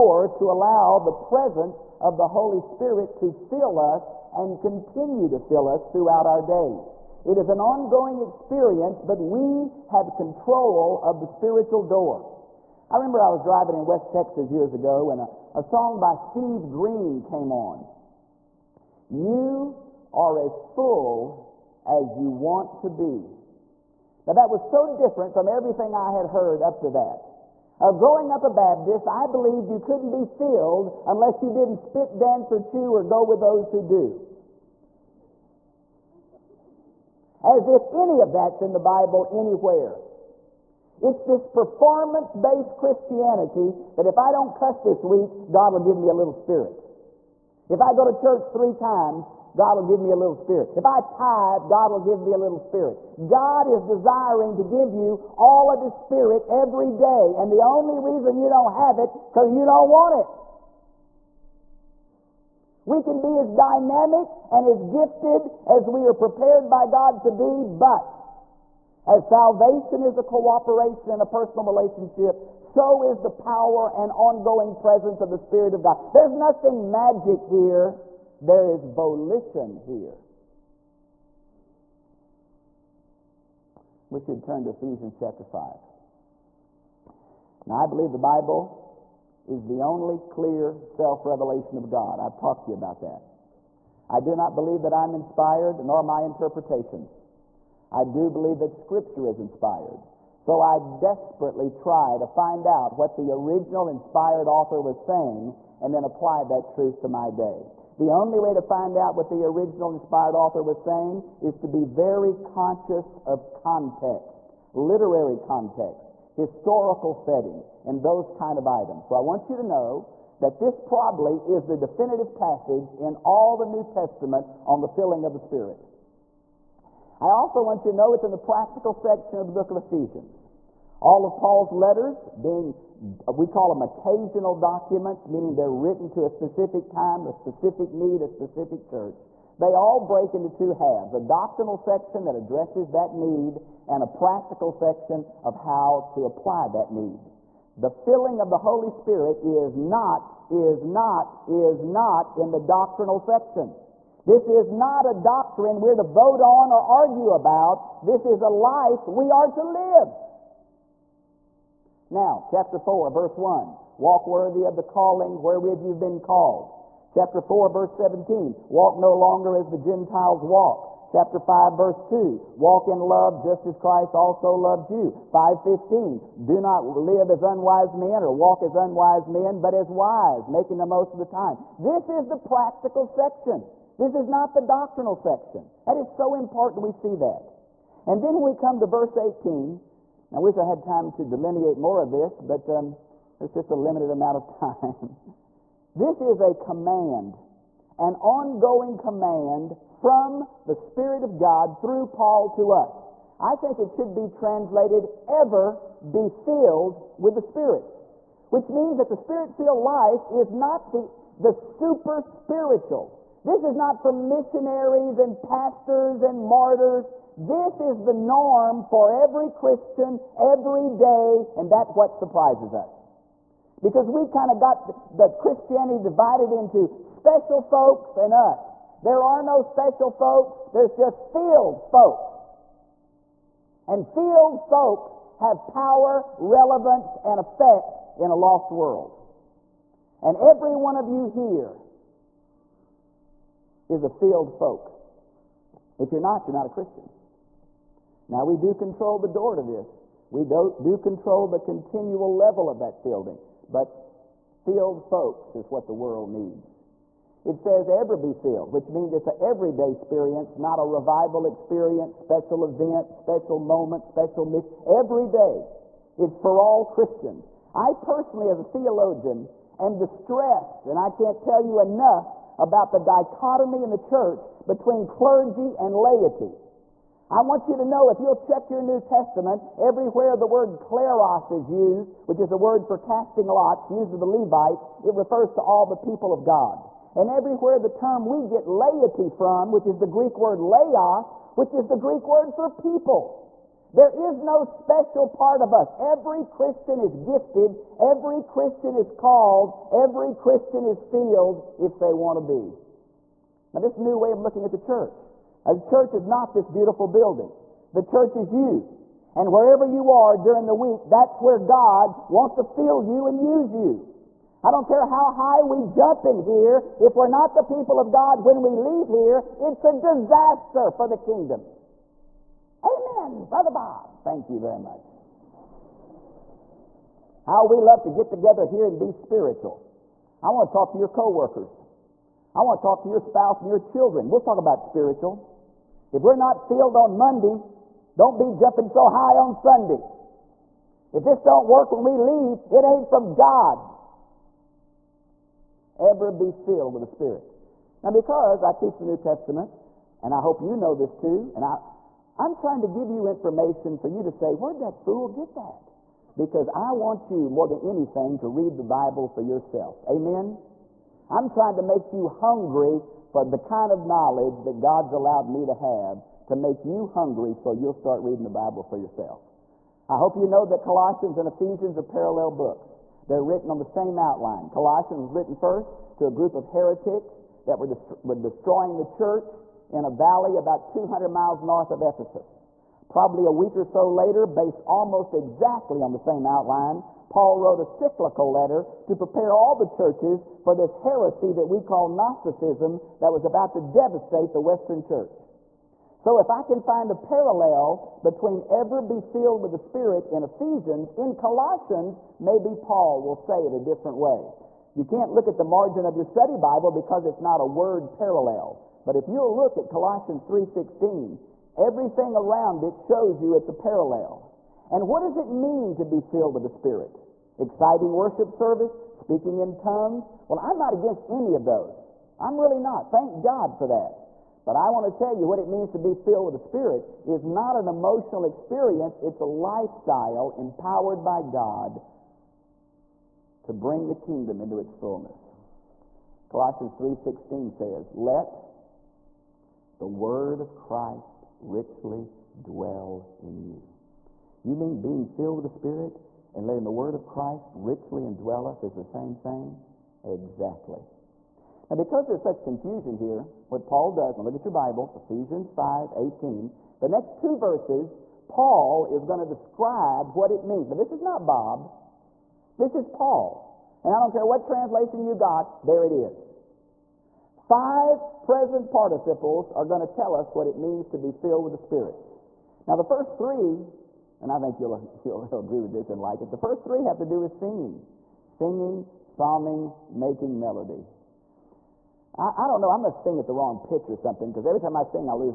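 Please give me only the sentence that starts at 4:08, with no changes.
Now, we do control the door to this.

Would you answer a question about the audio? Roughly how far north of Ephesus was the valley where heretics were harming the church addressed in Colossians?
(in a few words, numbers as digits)
200 miles.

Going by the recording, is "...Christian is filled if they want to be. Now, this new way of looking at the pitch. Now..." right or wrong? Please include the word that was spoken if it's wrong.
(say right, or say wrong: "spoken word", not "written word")
wrong: "church", not "pitch".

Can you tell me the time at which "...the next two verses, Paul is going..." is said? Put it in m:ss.
7:36.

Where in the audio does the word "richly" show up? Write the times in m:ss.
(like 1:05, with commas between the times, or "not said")
7:21, 7:27.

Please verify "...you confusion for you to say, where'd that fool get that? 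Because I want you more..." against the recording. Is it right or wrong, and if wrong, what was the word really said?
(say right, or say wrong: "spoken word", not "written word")
wrong: "information", not "confusion".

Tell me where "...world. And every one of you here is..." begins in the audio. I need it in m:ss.
3:58.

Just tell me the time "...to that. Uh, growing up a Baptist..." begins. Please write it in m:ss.
0:26.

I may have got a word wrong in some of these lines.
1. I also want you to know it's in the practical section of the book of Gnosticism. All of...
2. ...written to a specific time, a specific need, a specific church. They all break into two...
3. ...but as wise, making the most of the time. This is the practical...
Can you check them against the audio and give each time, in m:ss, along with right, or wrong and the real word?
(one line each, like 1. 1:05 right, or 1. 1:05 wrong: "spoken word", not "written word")
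1. 2:07 wrong: "Ephesians", not "Gnosticism"
2. 2:15 right
3. 2:59 right.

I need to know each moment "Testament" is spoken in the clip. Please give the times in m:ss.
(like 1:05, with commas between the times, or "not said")
2:03, 4:39, 5:49.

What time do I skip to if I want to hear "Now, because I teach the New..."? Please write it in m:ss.
5:48.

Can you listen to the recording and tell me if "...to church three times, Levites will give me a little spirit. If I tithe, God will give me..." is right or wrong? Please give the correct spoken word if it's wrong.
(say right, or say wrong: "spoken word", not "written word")
wrong: "God", not "Levites".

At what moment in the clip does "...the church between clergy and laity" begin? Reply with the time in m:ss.
4:33.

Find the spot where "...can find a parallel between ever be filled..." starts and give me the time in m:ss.
6:36.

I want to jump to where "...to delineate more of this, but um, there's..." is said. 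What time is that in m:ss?
3:11.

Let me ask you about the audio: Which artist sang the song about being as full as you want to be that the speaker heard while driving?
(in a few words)
Steve Green.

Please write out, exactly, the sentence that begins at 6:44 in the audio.
You can't look at the margin of your study Bible because it's not a word parallel.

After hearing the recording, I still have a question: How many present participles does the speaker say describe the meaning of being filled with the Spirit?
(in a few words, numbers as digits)
5.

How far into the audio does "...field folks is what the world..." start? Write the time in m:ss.
4:14.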